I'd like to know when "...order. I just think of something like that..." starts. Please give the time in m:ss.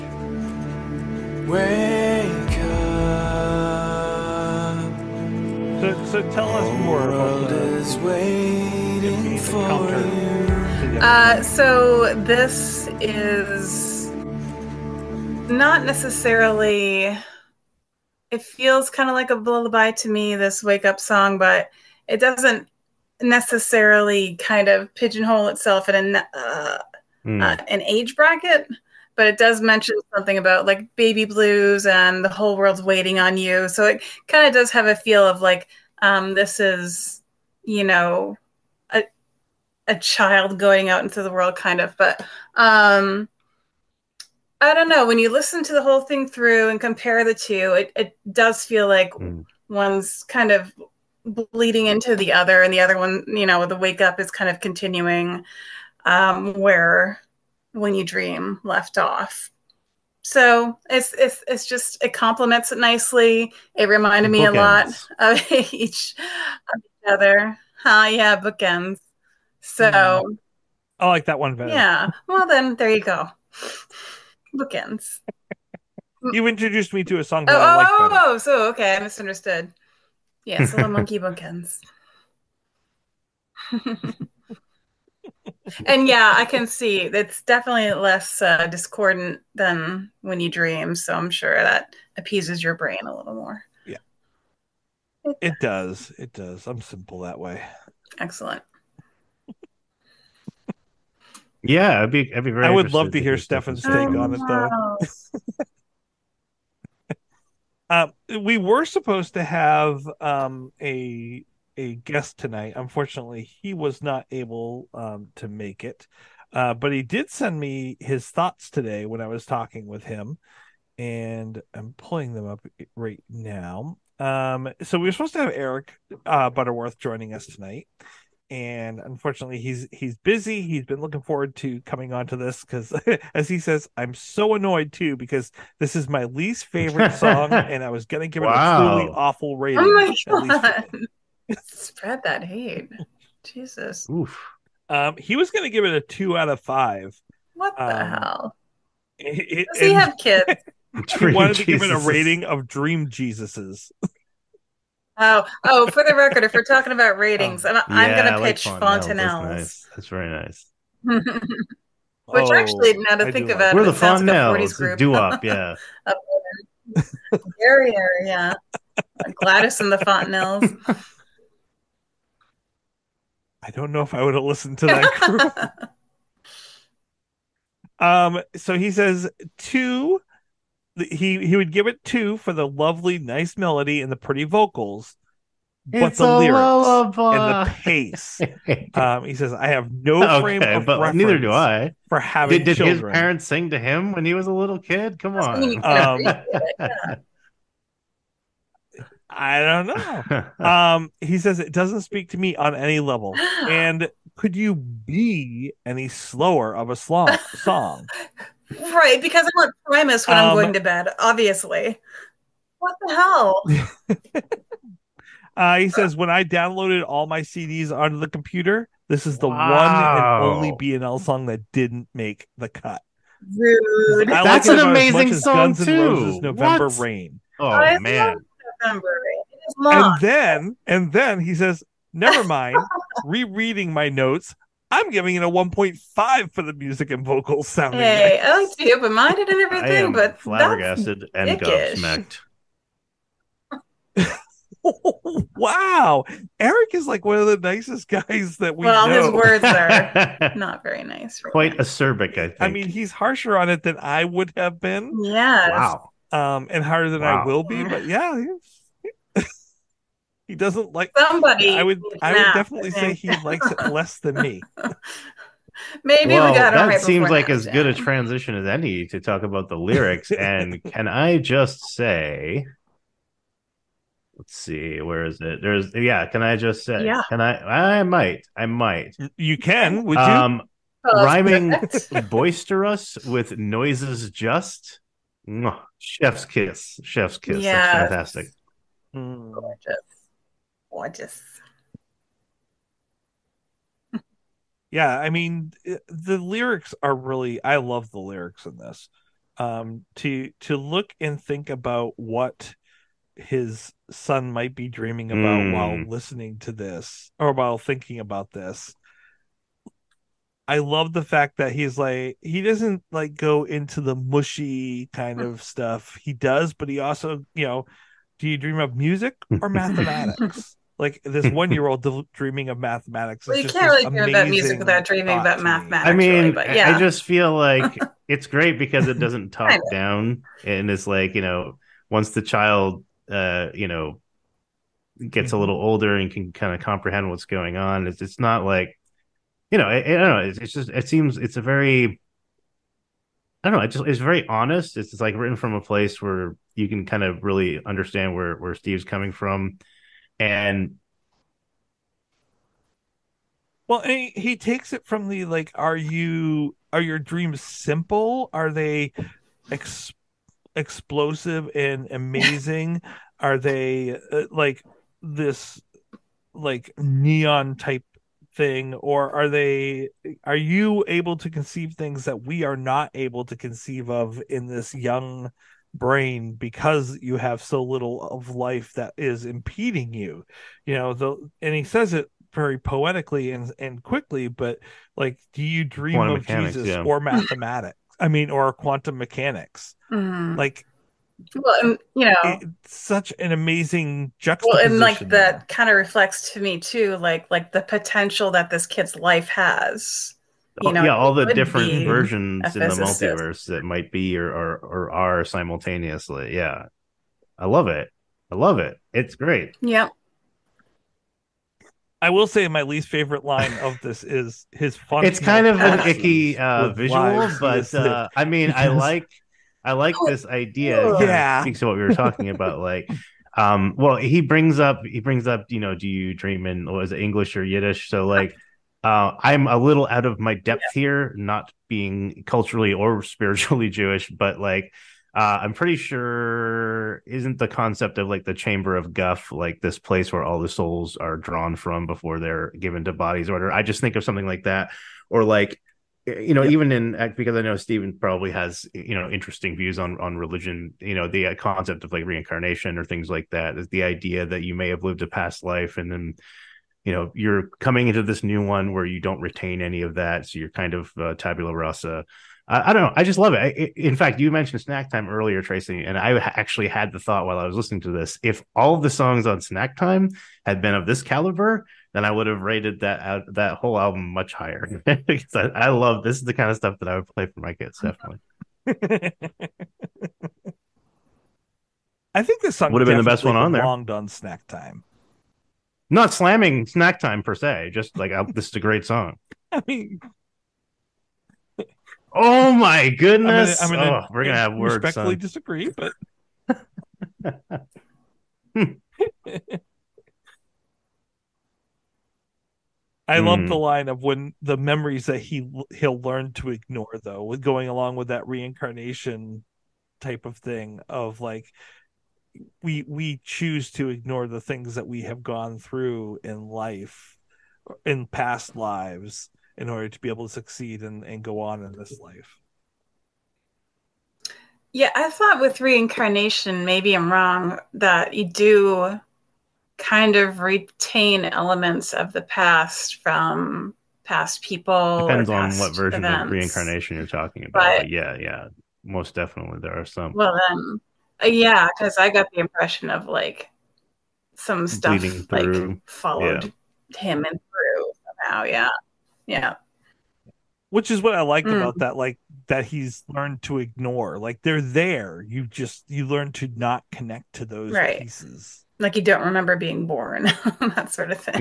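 7:23.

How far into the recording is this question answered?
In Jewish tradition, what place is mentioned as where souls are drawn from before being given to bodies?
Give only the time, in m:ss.
7:18.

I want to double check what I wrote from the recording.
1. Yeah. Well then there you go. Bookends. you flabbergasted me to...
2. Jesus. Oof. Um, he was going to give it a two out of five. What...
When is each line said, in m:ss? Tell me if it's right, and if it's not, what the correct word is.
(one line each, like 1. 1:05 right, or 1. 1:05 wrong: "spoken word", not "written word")
1. 1:11 wrong: "introduced", not "flabbergasted"
2. 2:23 right.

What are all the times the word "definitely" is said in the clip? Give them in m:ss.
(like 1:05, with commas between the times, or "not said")
1:27, 4:22, 7:58, 8:59.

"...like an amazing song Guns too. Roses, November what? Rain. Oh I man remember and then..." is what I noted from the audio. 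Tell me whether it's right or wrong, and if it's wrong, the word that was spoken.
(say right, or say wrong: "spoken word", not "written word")
right.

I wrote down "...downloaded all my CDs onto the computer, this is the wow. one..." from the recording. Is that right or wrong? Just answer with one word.
right.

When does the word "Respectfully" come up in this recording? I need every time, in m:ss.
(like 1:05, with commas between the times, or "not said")
8:15.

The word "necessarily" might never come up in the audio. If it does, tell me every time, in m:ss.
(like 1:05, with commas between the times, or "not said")
0:15, 0:23.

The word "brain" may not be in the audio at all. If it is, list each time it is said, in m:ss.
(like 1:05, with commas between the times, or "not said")
1:32, 6:15.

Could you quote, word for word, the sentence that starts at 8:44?
Yeah, I thought with reincarnation, maybe I'm wrong, that you do kind of retain elements of the past from past people.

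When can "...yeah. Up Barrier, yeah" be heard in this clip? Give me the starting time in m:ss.
2:45.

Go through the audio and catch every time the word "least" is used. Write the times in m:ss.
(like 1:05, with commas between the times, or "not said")
2:16, 6:52.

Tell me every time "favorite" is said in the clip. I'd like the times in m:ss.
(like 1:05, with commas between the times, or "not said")
2:16, 6:53.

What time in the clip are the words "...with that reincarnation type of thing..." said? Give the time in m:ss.
8:28.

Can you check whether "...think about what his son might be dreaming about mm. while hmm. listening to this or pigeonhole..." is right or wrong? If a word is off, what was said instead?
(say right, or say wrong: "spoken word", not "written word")
wrong: "while", not "pigeonhole".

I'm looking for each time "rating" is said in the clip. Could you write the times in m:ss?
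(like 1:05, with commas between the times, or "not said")
2:19, 2:31, 2:37.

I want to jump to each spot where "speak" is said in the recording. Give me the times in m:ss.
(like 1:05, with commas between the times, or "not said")
3:22, 7:01.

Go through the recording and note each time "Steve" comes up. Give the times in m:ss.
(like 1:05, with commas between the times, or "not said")
5:48.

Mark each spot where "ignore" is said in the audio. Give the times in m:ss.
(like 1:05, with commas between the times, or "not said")
8:26, 8:34, 9:13.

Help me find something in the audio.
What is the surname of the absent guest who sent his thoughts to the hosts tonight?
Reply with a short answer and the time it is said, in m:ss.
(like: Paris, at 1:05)
Butterworth, at 2:06.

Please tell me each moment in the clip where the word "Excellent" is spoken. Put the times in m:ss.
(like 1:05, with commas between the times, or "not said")
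1:38.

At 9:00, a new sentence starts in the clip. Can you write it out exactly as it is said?
Well, then, uh, yeah, because I got the impression of like some stuff like followed yeah.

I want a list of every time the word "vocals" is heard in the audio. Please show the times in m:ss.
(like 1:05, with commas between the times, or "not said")
3:04, 3:57.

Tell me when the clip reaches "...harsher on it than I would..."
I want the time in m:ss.
4:13.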